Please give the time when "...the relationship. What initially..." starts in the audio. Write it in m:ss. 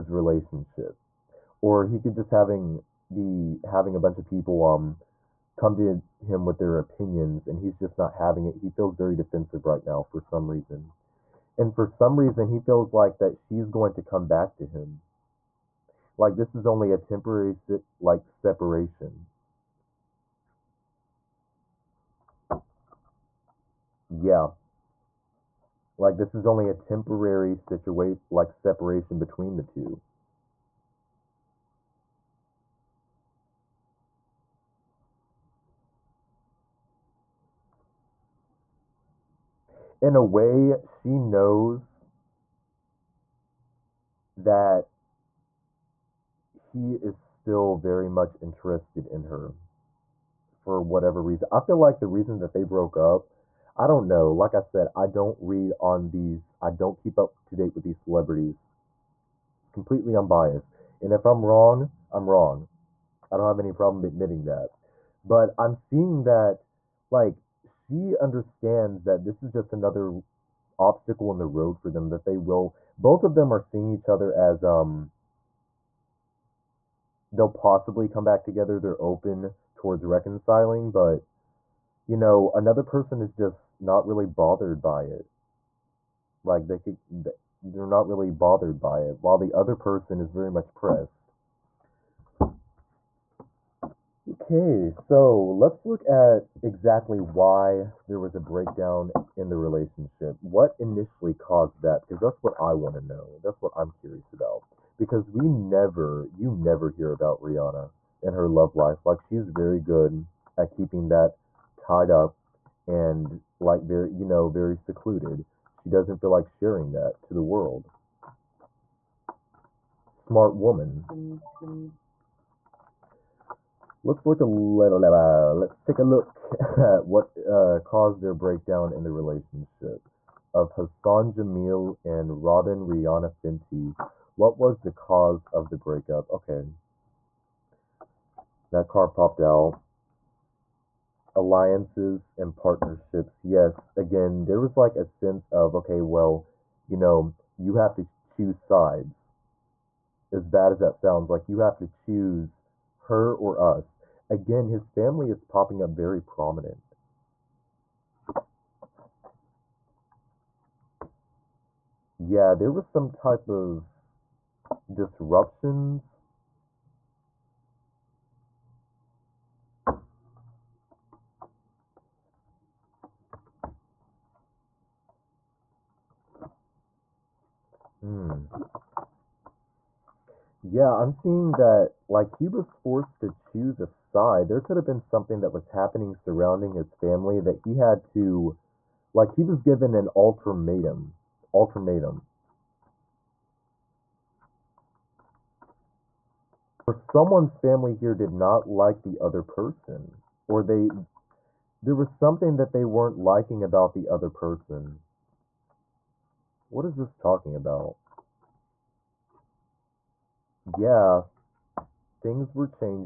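1:39.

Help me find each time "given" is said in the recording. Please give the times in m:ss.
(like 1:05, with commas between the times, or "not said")
3:09.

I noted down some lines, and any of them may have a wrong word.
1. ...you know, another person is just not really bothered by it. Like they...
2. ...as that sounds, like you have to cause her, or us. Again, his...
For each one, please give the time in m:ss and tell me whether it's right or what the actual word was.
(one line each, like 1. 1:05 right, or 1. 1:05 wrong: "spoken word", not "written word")
1. 1:22 right
2. 2:30 wrong: "choose", not "cause".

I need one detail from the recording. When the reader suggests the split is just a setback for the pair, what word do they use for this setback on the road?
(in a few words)
obstacle.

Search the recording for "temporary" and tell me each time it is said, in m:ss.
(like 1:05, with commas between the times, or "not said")
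0:16, 0:26.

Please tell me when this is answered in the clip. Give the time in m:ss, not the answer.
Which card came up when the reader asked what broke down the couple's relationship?
2:21.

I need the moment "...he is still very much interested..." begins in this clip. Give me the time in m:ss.
0:46.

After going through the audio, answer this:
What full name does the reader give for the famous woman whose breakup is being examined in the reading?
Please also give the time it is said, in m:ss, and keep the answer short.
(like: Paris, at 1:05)
Robyn Rihanna Fenty, at 2:12.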